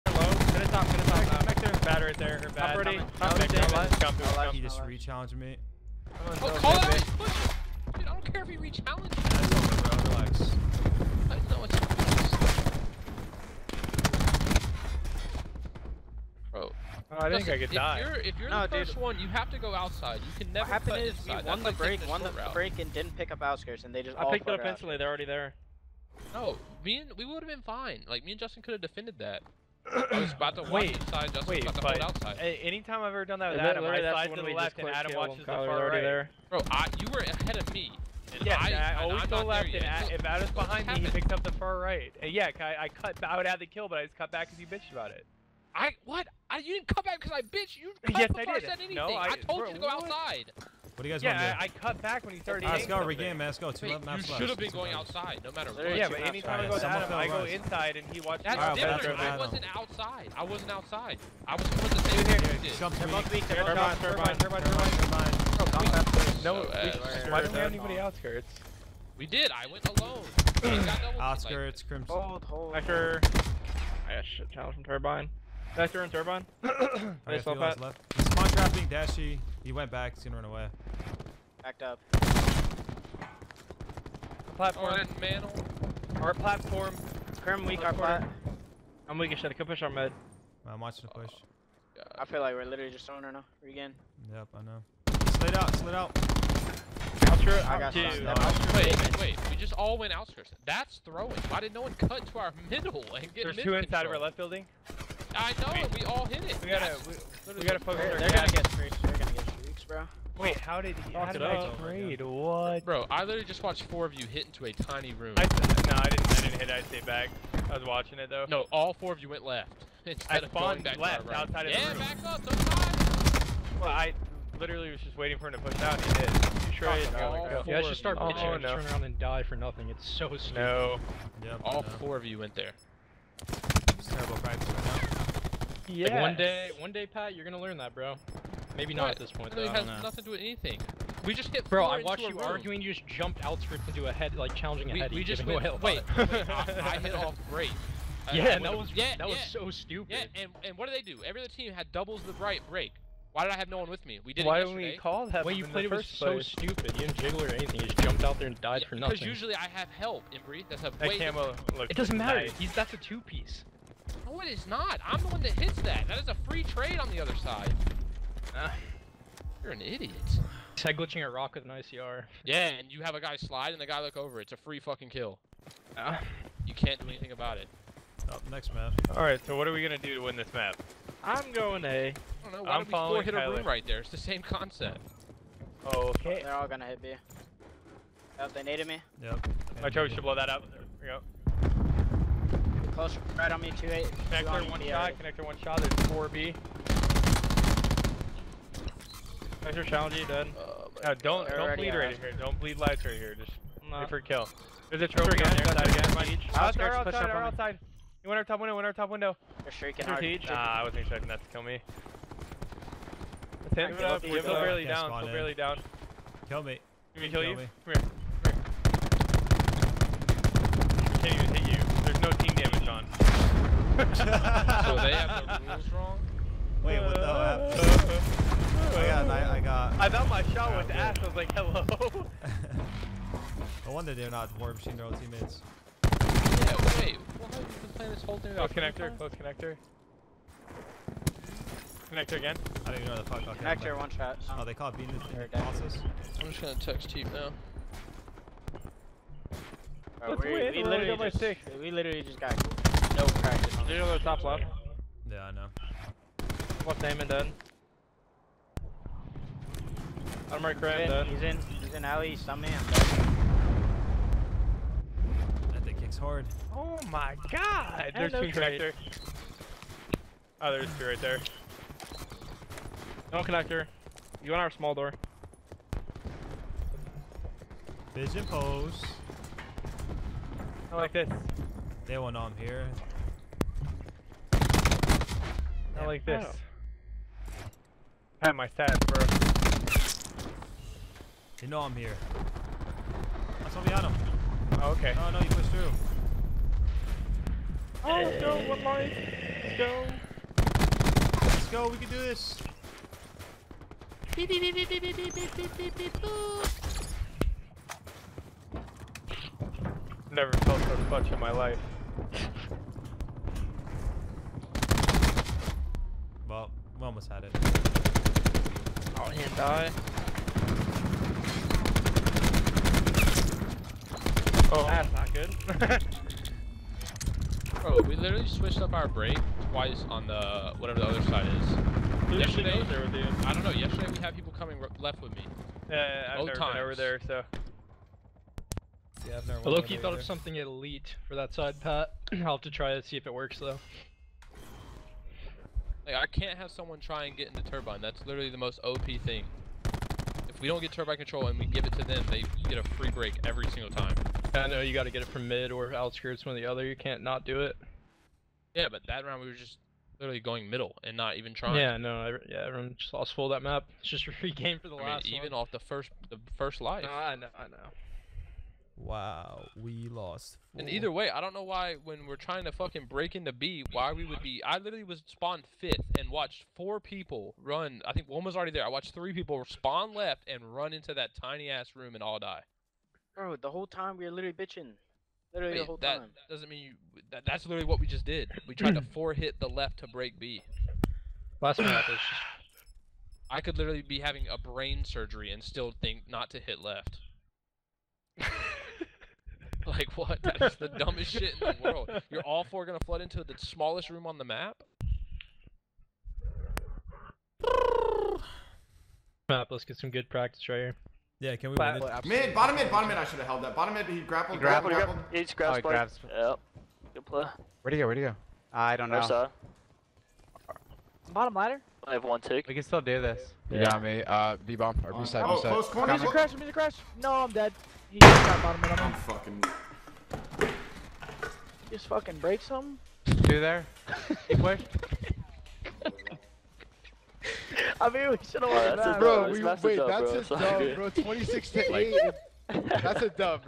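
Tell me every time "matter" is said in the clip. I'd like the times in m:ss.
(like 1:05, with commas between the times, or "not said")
0:55, 2:42.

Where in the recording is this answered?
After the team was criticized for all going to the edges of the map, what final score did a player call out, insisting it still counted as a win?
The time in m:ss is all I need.
7:21.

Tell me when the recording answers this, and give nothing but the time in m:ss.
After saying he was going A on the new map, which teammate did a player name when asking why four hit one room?
3:03.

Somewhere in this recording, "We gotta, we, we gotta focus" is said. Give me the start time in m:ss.
1:46.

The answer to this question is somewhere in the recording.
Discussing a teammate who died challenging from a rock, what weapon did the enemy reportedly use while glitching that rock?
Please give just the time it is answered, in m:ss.
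2:51.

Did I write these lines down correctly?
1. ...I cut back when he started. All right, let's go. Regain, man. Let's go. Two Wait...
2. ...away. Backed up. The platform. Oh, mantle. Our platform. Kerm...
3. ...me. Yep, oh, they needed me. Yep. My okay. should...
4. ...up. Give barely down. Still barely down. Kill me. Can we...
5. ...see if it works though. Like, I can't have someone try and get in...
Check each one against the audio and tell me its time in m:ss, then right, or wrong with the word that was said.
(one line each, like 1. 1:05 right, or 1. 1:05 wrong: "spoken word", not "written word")
1. 0:51 right
2. 1:20 right
3. 3:07 right
4. 3:34 right
5. 5:43 right.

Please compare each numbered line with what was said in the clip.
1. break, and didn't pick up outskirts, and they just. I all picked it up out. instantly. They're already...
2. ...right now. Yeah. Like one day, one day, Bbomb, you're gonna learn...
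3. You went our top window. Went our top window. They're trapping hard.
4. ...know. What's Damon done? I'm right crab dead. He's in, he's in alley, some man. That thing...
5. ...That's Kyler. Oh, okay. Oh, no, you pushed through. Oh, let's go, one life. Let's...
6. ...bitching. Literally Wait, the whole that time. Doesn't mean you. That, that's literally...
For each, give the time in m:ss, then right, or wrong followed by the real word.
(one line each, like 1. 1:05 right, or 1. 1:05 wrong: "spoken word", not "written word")
1. 0:22 right
2. 2:14 wrong: "Pat", not "Bbomb"
3. 3:28 wrong: "shrieking", not "trapping"
4. 4:15 right
5. 4:53 wrong: "Oliano", not "Kyler"
6. 6:24 right.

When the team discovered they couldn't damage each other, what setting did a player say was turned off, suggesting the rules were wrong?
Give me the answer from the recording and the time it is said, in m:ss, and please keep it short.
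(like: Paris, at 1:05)
team damage, at 3:42.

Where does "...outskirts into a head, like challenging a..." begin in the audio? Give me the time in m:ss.
2:23.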